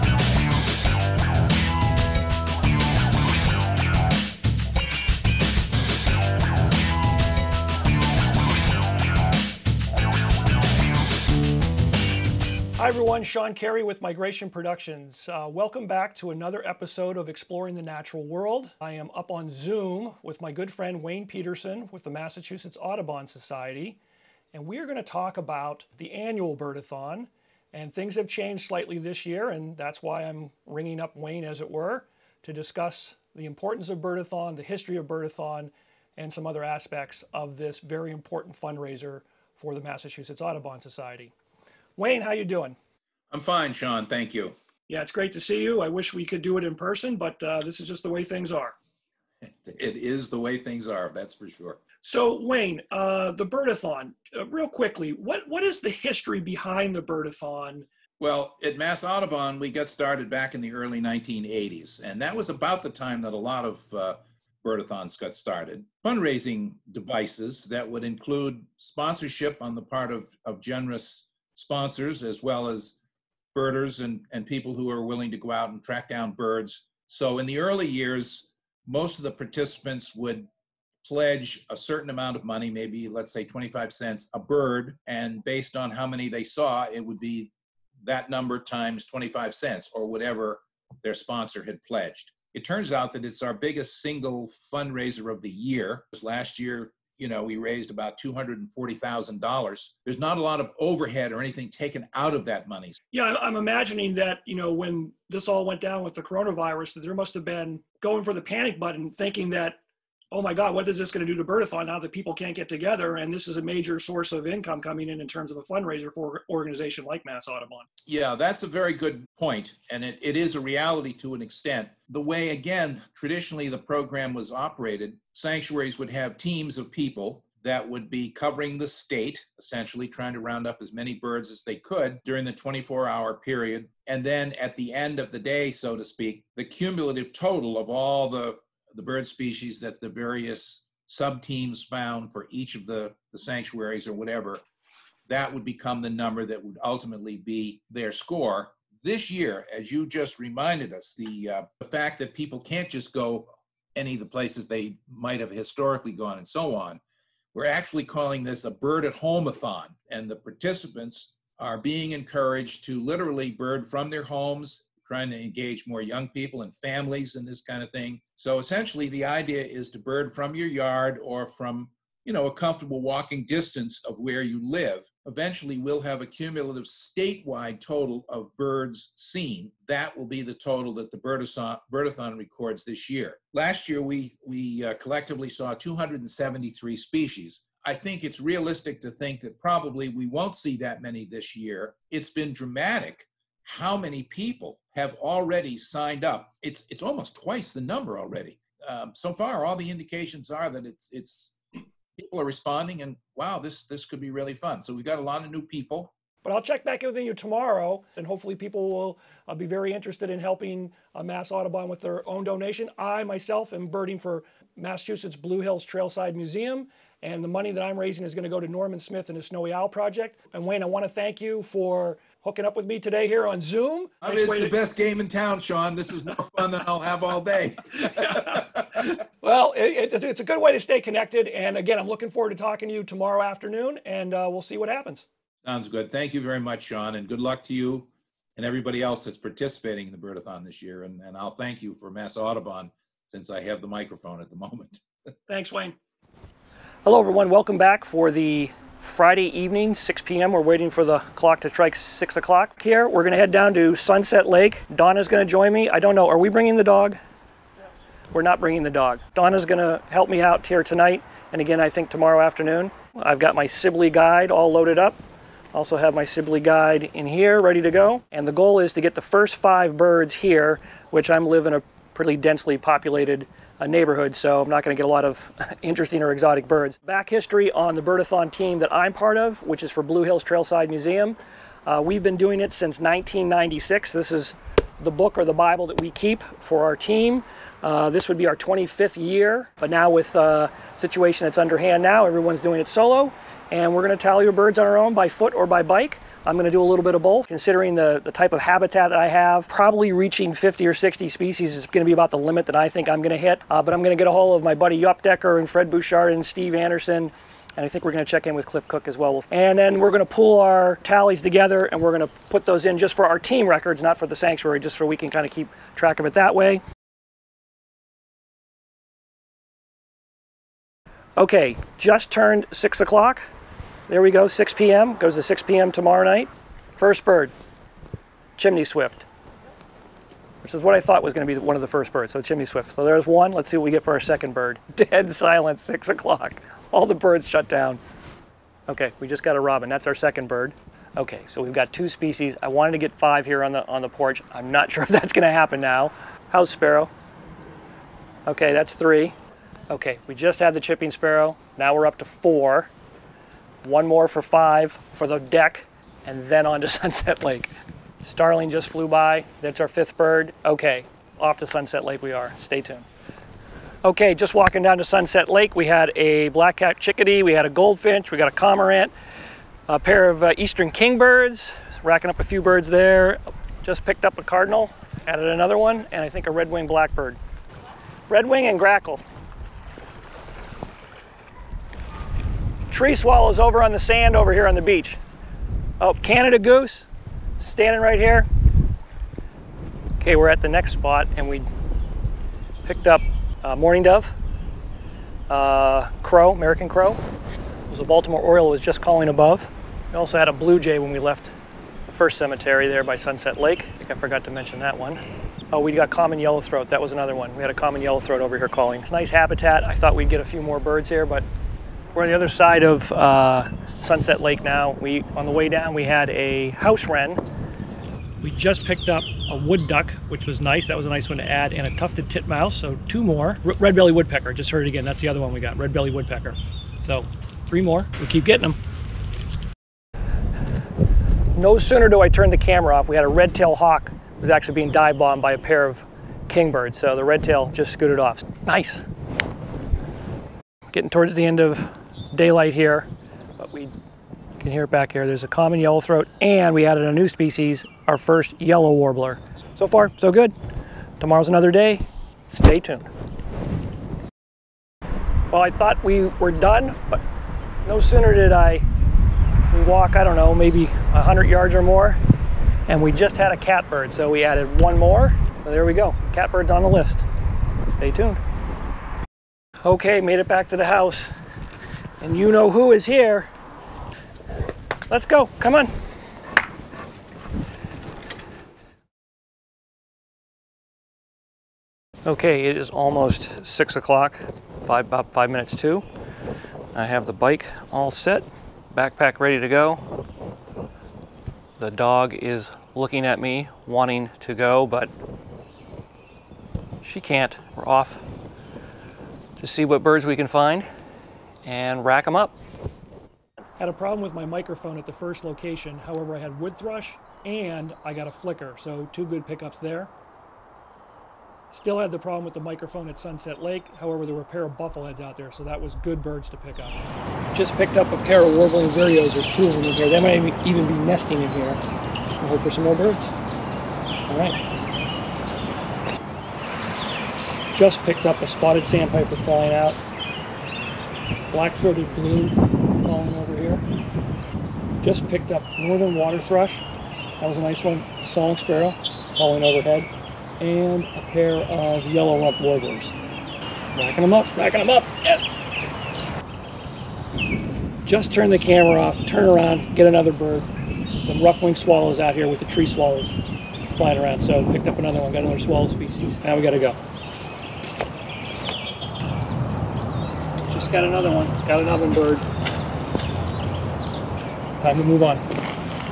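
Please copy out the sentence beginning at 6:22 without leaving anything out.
tree swallows over on the sand over here on the beach.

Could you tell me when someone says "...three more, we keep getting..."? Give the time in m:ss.
7:07.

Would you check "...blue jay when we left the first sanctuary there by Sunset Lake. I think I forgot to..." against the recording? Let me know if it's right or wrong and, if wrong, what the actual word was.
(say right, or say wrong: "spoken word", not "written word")
wrong: "cemetery", not "sanctuary".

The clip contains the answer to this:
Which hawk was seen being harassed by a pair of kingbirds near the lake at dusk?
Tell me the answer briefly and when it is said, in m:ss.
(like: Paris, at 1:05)
red-tail hawk, at 7:13.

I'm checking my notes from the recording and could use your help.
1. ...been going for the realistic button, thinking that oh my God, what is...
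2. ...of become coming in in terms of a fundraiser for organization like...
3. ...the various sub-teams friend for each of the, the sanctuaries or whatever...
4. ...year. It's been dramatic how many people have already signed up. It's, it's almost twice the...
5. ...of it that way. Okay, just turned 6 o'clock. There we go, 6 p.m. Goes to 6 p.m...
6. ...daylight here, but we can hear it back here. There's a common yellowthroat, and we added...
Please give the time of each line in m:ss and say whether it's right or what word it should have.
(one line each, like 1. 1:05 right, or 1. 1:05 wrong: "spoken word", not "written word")
1. 1:47 wrong: "panic", not "realistic"
2. 1:54 wrong: "income", not "become"
3. 2:20 wrong: "found", not "friend"
4. 3:11 right
5. 5:16 right
6. 7:22 right.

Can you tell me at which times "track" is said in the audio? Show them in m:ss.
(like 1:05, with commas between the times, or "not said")
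1:15, 5:15.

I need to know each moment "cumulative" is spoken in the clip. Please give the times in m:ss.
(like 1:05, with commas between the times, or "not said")
2:16, 2:56.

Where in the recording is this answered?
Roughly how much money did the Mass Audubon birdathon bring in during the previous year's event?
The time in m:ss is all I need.
1:38.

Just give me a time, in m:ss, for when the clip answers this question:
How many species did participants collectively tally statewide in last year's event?
3:05.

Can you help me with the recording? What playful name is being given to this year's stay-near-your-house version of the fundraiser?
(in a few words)
bird at home-a-thon.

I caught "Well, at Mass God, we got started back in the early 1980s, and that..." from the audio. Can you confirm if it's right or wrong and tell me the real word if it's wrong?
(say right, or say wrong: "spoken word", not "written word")
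wrong: "Audubon", not "God".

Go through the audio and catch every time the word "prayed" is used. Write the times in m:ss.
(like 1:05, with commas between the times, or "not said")
not said.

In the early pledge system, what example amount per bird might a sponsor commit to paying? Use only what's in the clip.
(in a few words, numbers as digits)
25 cents.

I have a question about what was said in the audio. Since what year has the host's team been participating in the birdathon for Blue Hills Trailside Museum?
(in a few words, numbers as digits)
1996.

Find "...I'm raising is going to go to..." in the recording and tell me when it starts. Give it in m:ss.
3:37.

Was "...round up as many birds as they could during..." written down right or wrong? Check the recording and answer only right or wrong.
right.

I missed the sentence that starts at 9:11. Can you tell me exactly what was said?
Some rough-winged swallows out here with the tree swallows flying around.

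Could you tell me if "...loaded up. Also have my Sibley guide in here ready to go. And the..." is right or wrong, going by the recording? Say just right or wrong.
right.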